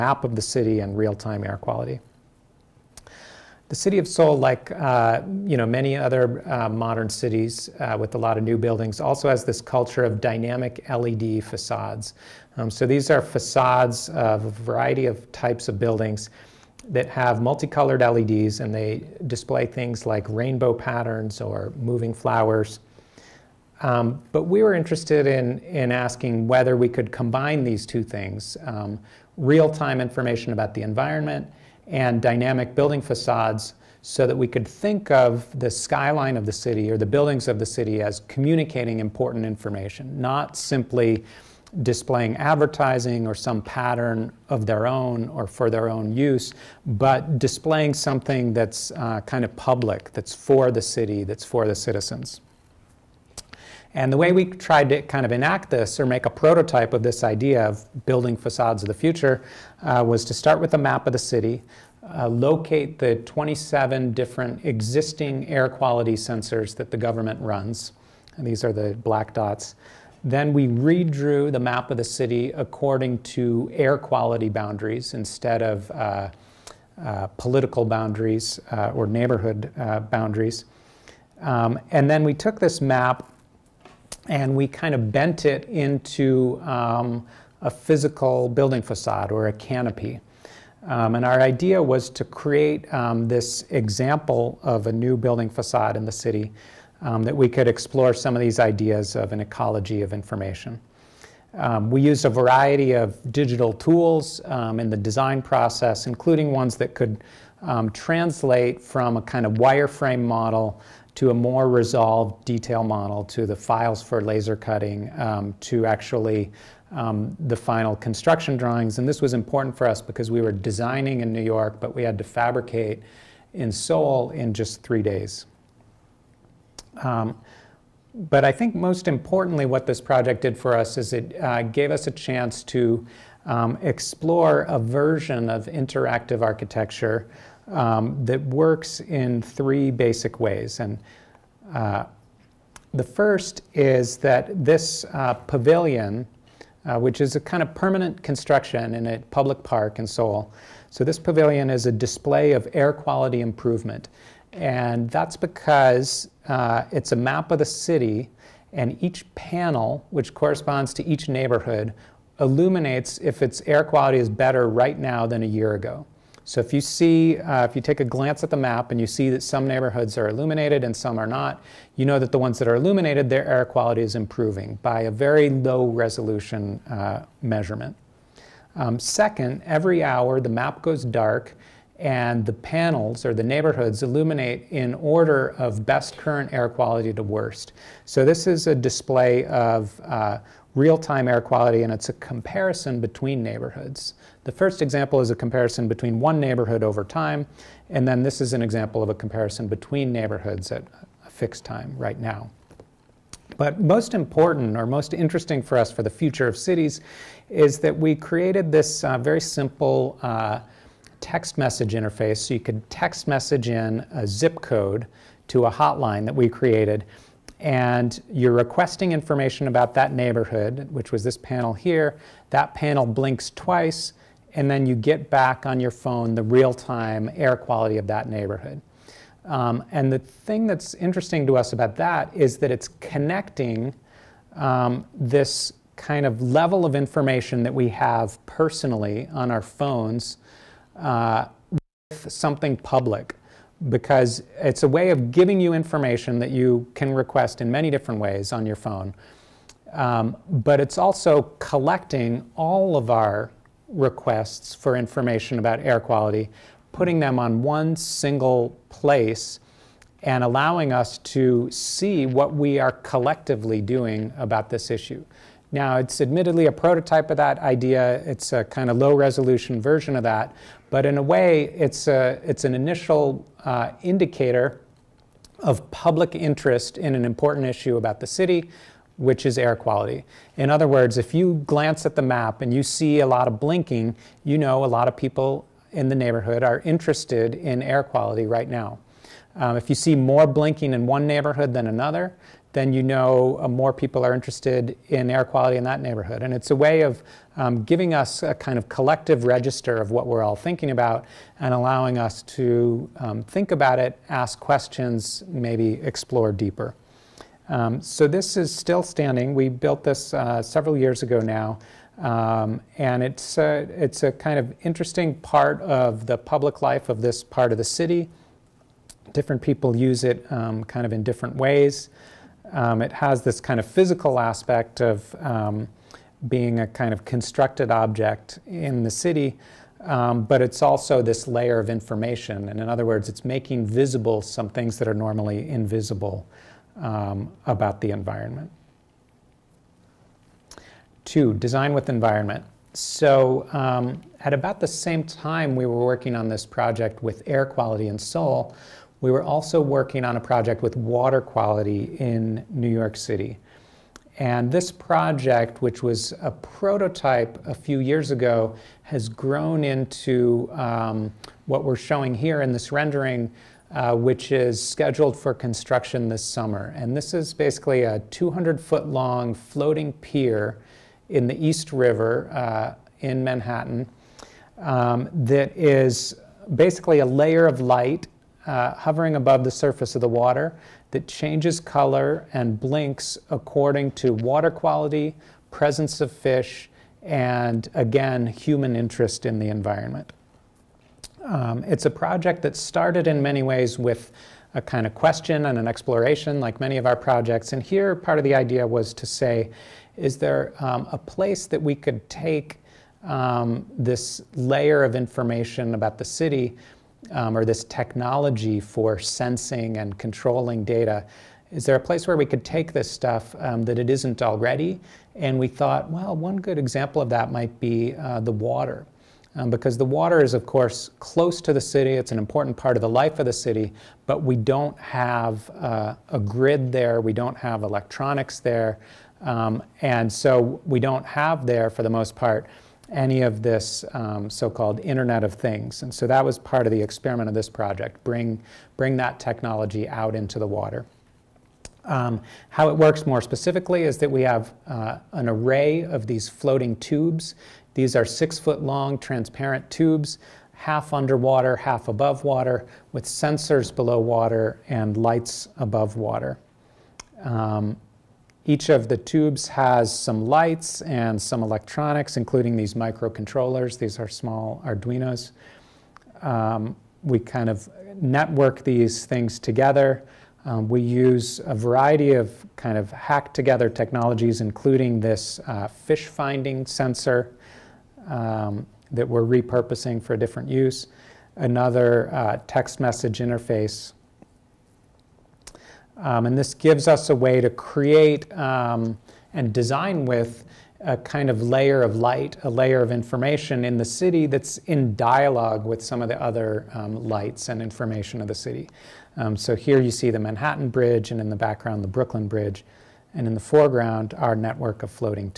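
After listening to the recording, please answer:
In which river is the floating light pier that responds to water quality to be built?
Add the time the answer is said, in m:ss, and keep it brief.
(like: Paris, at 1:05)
East River, at 6:11.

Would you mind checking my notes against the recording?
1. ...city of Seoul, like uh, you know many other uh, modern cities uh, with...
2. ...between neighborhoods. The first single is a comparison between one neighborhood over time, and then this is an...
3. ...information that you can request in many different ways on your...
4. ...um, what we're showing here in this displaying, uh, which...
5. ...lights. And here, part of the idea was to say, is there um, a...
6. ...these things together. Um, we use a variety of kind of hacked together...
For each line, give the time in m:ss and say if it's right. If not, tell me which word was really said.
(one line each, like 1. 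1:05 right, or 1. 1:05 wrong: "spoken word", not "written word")
1. 0:03 right
2. 3:13 wrong: "example", not "single"
3. 4:05 right
4. 6:00 wrong: "rendering", not "displaying"
5. 6:37 wrong: "projects", not "lights"
6. 7:48 right.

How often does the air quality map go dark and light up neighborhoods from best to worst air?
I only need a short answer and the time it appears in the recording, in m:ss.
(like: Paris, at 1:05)
Every hour, at 2:59.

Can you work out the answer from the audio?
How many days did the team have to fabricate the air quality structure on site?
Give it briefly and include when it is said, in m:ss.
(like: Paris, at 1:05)
3, at 2:04.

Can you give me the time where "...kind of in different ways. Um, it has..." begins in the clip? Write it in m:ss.
5:20.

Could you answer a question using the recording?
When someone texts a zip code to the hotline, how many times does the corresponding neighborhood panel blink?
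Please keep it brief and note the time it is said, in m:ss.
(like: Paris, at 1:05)
Twice, at 3:43.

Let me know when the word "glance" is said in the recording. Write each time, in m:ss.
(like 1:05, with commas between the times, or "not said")
2:48, 4:41.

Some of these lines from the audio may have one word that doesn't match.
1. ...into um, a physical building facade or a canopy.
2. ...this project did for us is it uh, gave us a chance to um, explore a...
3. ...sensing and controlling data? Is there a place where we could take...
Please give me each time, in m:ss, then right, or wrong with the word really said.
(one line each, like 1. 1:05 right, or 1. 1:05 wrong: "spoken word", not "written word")
1. 1:25 right
2. 2:09 right
3. 6:49 right.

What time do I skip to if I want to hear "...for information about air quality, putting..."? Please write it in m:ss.
4:14.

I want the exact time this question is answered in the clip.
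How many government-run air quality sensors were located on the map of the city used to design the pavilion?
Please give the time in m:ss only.
1:03.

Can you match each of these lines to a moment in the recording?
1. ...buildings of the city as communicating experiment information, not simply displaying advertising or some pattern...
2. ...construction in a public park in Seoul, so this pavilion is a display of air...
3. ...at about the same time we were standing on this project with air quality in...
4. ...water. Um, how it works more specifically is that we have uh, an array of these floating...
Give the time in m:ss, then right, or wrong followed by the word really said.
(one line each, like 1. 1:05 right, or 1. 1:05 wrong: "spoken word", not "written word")
1. 0:37 wrong: "important", not "experiment"
2. 2:28 right
3. 5:44 wrong: "working", not "standing"
4. 7:20 right.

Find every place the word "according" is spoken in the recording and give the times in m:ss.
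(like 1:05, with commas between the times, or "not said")
1:12, 6:23.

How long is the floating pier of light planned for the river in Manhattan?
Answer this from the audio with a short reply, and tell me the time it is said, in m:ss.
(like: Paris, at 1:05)
200 feet, at 6:08.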